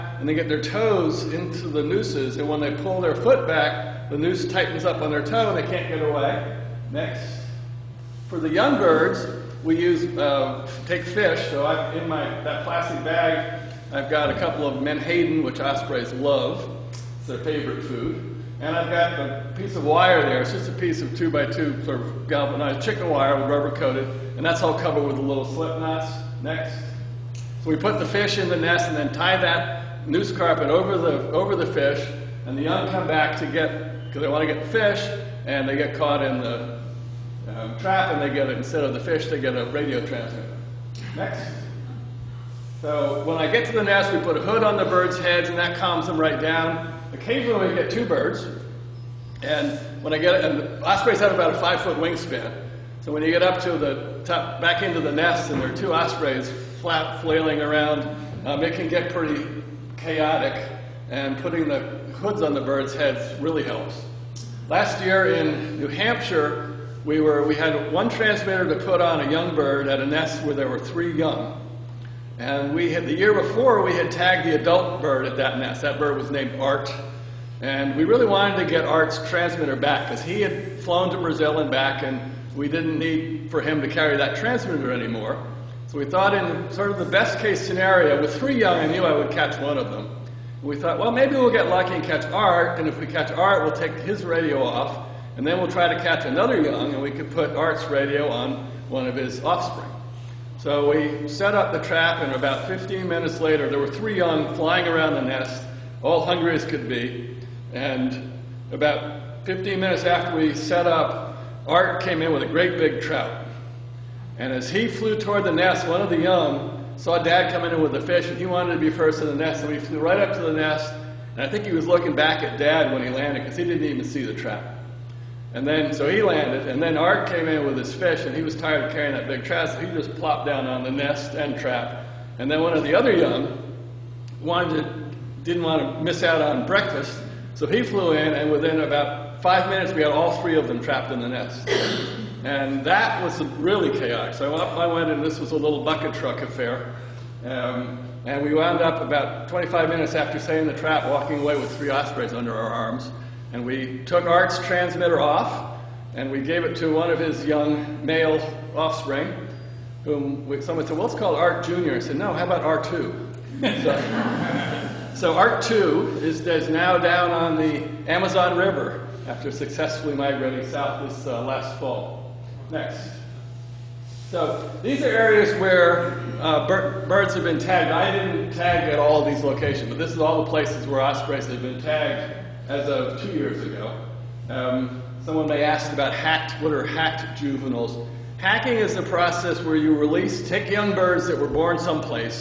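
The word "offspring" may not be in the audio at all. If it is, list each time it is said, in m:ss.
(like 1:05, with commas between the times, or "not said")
1:39, 2:38.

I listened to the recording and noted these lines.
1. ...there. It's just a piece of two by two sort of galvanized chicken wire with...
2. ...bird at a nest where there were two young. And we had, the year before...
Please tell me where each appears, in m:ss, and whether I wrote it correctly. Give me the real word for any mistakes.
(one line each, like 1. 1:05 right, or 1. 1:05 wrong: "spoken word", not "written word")
1. 0:20 right
2. 1:09 wrong: "three", not "two".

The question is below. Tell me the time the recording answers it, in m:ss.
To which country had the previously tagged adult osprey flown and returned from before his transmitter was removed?
1:21.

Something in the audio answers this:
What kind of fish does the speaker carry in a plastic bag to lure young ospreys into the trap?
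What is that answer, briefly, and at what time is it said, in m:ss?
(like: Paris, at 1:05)
Menhaden, at 0:14.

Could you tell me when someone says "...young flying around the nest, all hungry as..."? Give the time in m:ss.
1:44.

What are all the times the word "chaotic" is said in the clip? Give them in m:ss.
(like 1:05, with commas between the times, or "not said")
0:59, 2:23.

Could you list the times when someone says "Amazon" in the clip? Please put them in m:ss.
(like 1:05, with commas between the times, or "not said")
2:48.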